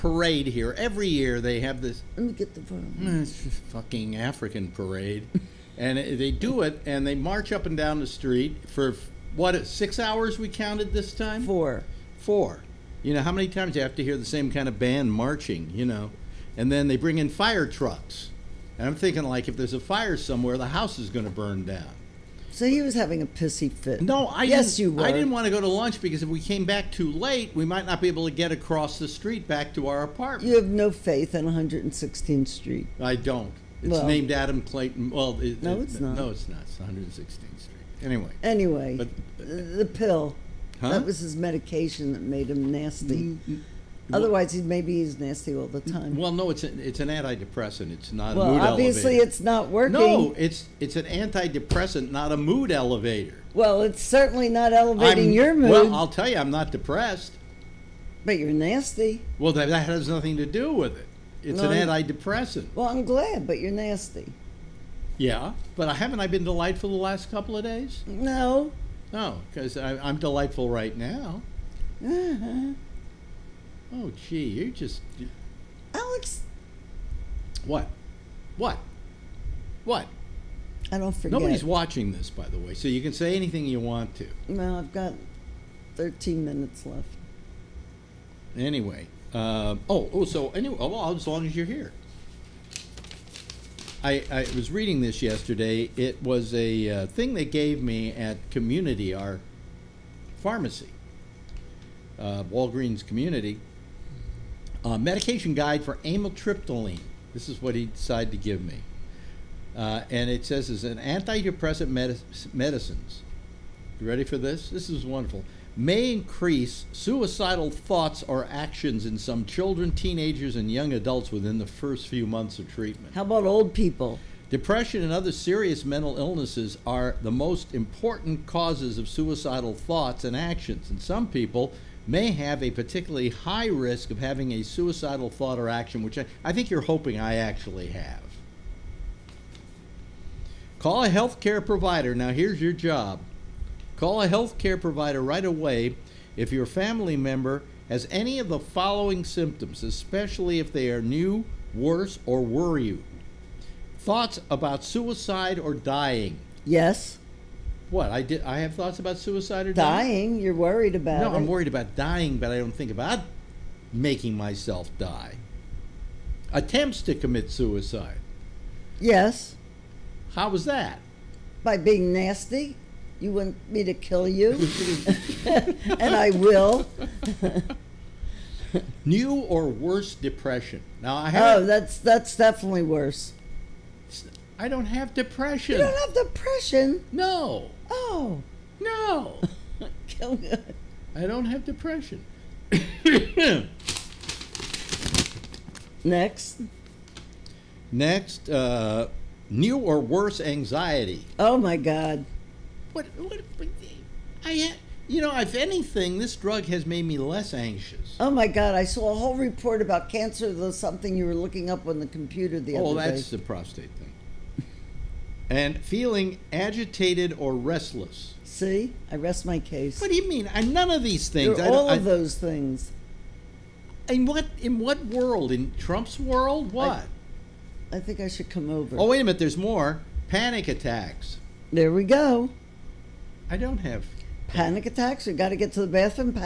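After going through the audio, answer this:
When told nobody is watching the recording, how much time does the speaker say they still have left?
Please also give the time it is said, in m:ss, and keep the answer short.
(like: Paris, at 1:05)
13 minutes, at 1:25.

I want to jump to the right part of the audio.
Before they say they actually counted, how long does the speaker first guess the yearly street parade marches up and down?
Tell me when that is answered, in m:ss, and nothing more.
0:09.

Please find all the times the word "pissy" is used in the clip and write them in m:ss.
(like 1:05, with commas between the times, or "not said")
0:23.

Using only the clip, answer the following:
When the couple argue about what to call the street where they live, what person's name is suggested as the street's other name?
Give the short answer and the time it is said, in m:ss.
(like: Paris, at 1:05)
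Adam Clayton, at 0:34.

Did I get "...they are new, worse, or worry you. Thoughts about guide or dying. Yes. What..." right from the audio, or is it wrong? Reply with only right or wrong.
wrong.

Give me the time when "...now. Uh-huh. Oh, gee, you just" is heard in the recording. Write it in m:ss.
1:10.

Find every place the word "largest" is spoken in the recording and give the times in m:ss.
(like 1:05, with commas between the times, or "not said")
not said.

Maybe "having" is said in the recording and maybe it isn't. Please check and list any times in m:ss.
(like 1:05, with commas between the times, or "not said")
0:22, 2:14.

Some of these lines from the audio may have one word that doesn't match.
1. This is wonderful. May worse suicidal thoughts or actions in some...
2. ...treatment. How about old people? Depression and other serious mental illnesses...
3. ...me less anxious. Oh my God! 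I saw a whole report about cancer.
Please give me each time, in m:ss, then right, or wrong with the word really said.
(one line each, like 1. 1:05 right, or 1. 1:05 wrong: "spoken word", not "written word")
1. 1:54 wrong: "increase", not "worse"
2. 2:02 right
3. 3:27 right.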